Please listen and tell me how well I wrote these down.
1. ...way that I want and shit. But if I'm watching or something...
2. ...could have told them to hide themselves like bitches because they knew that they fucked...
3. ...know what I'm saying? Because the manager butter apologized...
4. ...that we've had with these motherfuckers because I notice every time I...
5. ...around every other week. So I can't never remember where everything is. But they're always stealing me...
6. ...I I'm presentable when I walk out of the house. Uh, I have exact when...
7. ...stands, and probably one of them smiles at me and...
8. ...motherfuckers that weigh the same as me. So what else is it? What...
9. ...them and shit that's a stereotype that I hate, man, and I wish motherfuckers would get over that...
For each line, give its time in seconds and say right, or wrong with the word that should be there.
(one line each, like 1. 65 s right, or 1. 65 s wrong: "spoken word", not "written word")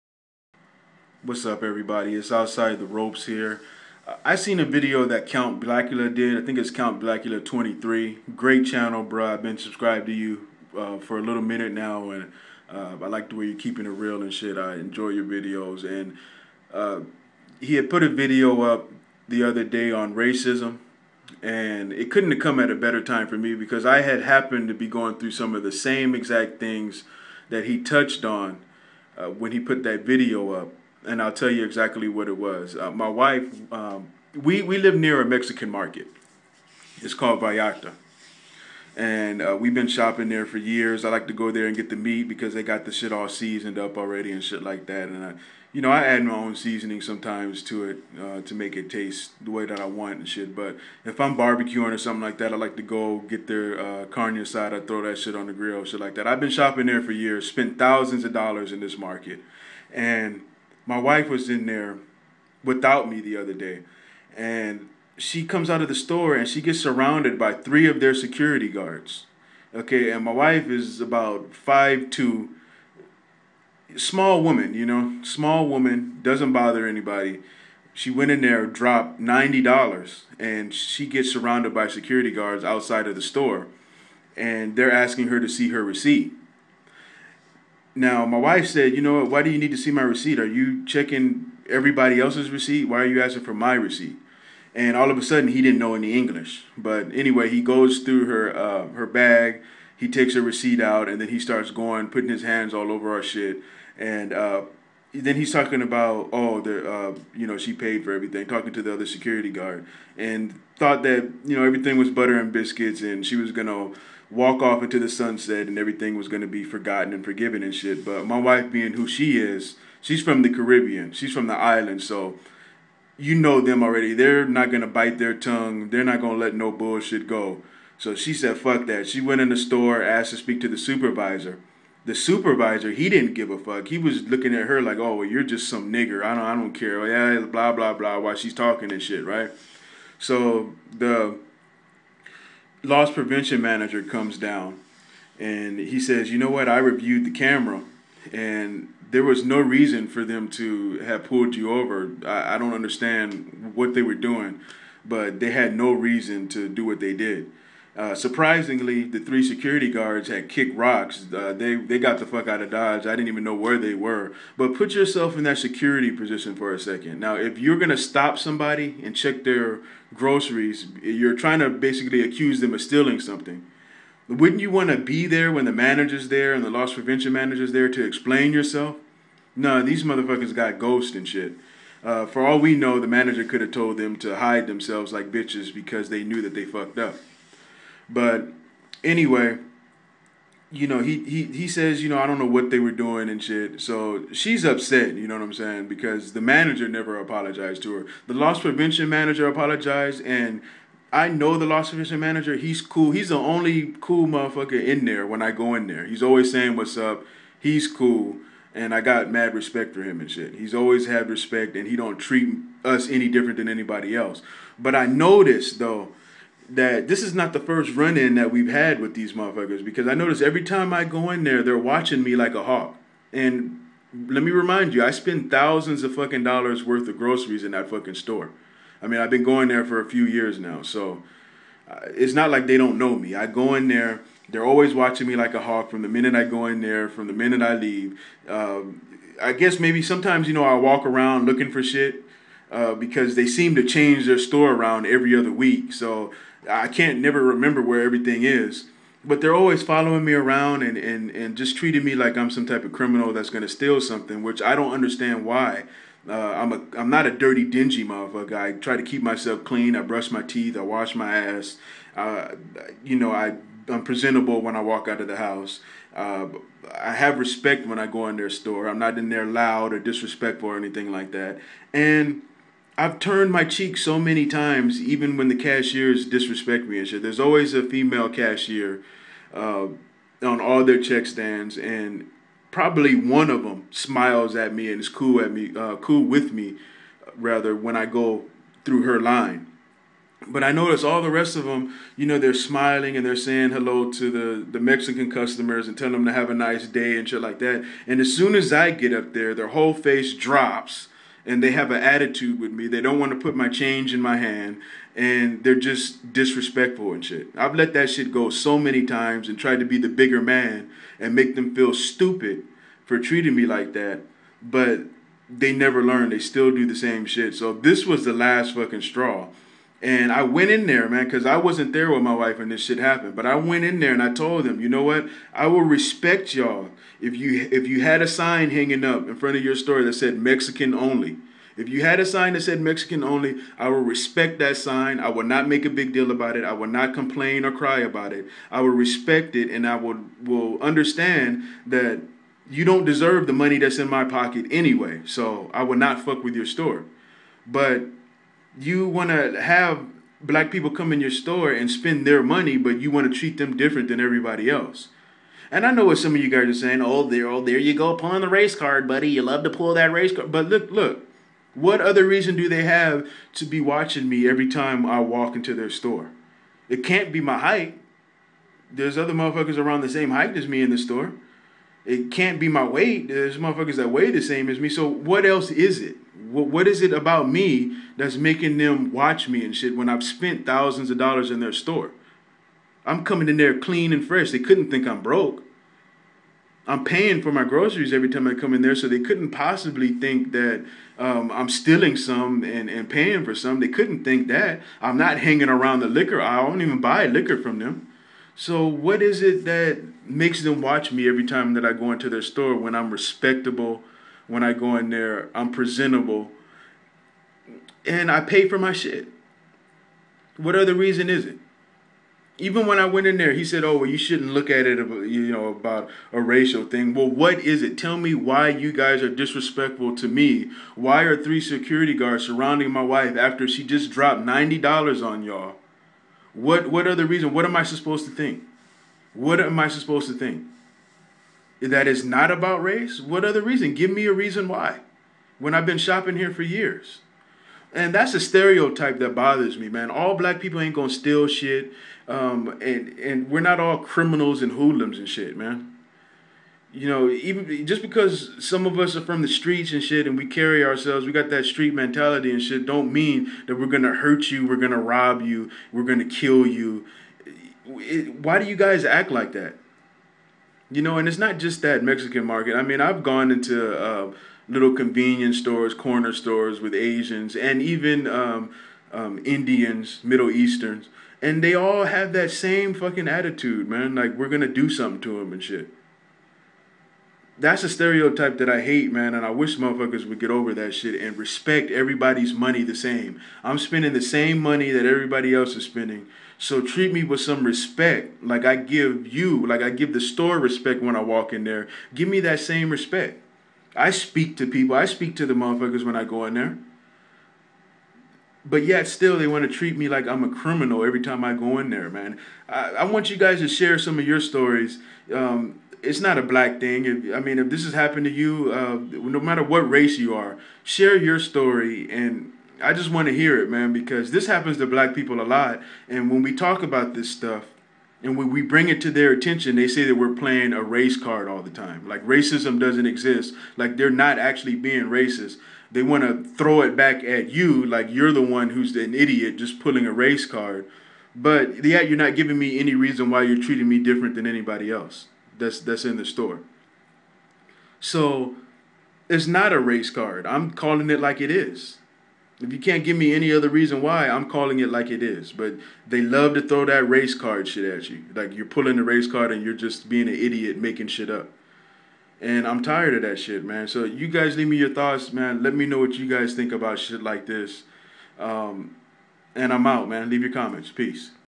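1. 49 s wrong: "barbecuing", not "watching"
2. 183 s right
3. 195 s wrong: "never", not "butter"
4. 218 s right
5. 244 s wrong: "following", not "stealing"
6. 263 s wrong: "respect", not "exact"
7. 281 s right
8. 373 s right
9. 475 s right.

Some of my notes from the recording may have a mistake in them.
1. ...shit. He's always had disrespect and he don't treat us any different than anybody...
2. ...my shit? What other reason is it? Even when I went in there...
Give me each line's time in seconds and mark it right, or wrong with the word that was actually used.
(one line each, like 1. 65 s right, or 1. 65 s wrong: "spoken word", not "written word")
1. 210 s wrong: "respect", not "disrespect"
2. 408 s right.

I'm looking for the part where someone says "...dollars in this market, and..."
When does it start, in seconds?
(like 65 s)
58 s.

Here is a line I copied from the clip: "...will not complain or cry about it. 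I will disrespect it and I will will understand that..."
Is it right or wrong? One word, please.
wrong.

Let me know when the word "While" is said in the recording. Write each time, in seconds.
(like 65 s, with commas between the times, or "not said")
138 s.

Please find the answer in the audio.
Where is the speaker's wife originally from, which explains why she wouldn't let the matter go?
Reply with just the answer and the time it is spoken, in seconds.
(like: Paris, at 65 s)
the Caribbean, at 120 s.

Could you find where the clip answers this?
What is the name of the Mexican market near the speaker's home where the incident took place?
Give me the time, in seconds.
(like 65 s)
37 s.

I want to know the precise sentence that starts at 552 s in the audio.
And I'm tired of that shit, man.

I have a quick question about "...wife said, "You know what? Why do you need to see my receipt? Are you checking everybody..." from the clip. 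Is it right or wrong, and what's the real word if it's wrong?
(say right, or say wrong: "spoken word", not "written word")
right.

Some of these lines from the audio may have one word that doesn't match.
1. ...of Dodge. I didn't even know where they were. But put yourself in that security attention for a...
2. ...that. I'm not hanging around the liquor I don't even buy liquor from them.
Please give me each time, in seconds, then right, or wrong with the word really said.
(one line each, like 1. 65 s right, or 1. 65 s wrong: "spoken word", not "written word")
1. 162 s wrong: "position", not "attention"
2. 394 s right.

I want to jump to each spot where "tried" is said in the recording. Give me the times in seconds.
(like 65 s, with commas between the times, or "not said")
309 s.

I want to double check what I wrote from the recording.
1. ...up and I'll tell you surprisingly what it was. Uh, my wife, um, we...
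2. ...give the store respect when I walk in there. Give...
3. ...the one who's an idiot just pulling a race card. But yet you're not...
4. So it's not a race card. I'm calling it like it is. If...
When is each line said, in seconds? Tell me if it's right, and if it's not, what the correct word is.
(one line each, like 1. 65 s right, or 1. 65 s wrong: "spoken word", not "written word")
1. 30 s wrong: "exactly", not "surprisingly"
2. 489 s right
3. 528 s right
4. 538 s right.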